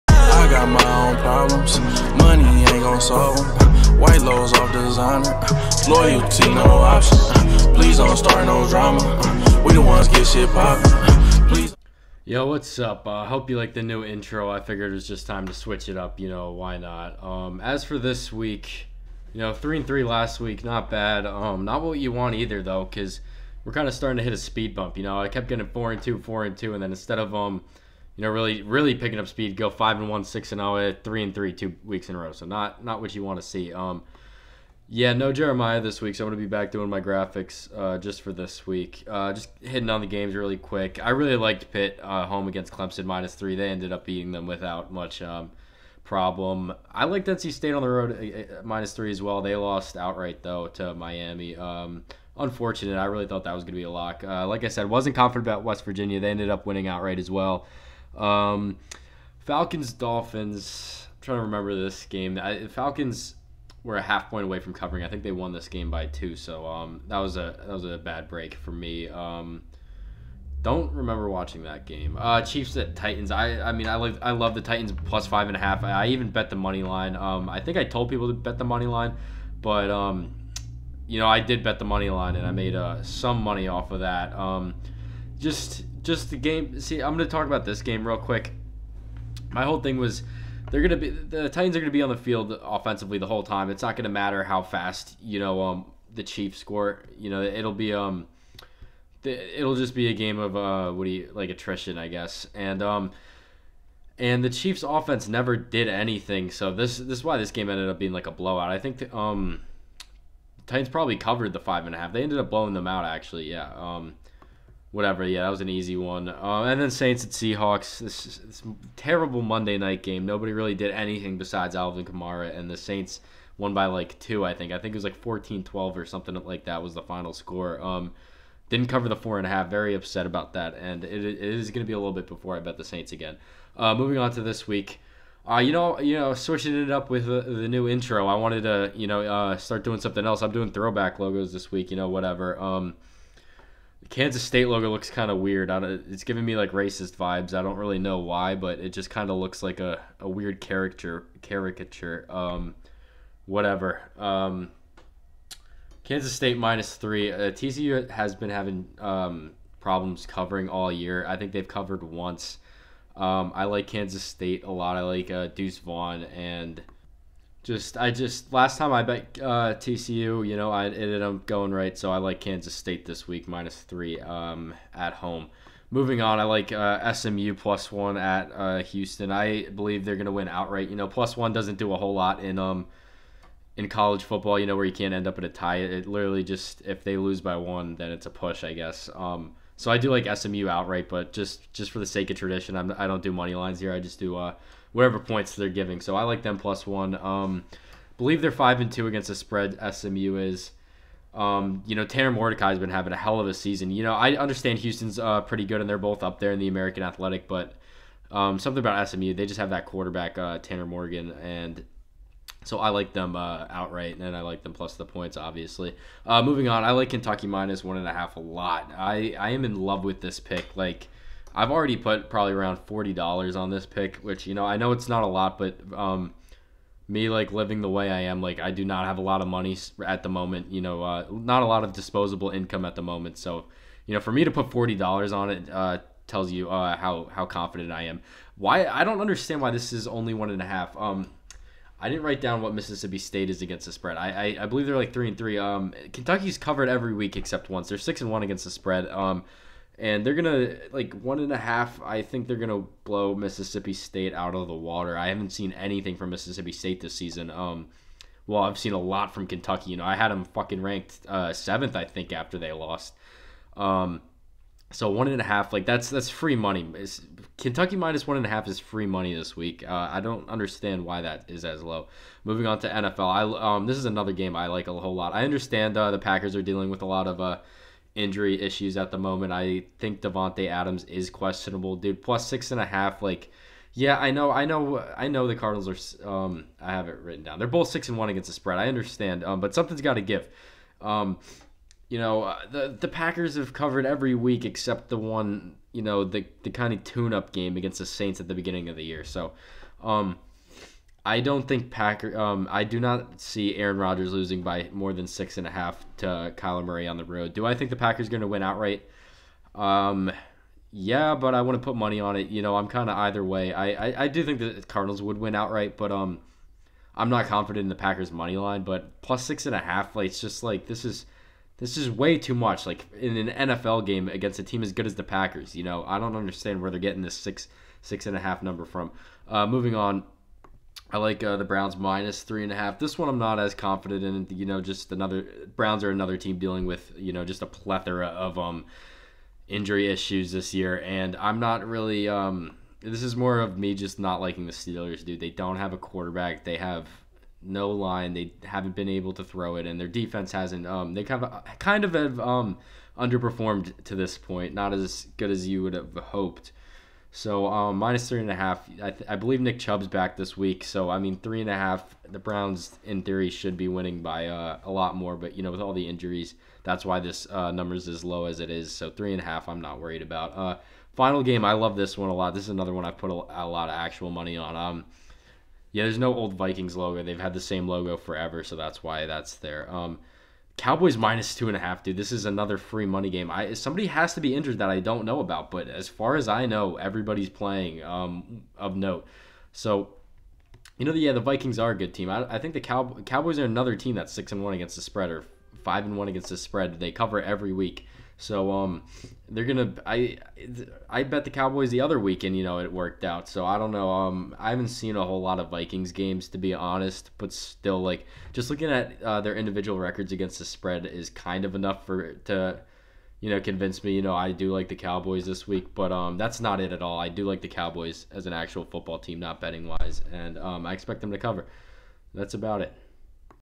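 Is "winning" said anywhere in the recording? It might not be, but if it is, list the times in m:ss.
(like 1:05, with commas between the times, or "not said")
0:56, 6:03.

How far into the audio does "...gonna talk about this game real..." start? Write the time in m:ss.
1:27.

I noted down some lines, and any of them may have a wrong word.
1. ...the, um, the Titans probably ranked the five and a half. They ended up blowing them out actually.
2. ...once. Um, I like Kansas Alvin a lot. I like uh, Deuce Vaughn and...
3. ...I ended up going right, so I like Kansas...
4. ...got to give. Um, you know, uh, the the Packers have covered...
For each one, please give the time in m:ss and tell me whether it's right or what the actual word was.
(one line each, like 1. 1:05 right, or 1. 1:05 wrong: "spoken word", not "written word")
1. 1:48 wrong: "covered", not "ranked"
2. 2:42 wrong: "State", not "Alvin"
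3. 2:50 right
4. 4:50 right.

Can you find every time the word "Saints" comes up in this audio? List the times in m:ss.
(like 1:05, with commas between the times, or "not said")
1:56, 2:02, 2:12, 4:58.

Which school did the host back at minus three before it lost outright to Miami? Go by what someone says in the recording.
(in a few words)
NC State.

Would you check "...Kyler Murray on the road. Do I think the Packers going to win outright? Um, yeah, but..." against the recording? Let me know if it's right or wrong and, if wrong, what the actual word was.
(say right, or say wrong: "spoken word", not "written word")
right.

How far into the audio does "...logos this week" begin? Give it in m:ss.
2:21.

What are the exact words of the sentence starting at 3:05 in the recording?
It literally just if they lose by one, then it's a push, I guess.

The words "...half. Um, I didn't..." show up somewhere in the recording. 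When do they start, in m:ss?
4:00.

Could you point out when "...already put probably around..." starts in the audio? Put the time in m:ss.
3:41.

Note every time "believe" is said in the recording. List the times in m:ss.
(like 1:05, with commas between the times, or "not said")
2:59, 3:18, 4:04, 5:59.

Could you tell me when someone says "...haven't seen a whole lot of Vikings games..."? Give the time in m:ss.
6:44.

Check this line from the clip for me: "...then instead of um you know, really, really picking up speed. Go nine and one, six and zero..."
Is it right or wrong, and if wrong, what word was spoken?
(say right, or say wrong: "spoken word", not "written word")
wrong: "five", not "nine".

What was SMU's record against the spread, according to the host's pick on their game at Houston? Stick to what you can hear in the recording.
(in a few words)
5-2.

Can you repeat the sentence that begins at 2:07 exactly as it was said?
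Um, didn't cover the four and a half.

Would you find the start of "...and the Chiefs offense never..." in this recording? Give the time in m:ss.
1:44.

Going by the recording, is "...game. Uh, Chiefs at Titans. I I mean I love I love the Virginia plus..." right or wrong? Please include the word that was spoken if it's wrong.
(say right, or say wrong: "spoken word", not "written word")
wrong: "Titans", not "Virginia".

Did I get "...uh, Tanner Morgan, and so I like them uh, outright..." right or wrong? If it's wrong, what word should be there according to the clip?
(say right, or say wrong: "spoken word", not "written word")
right.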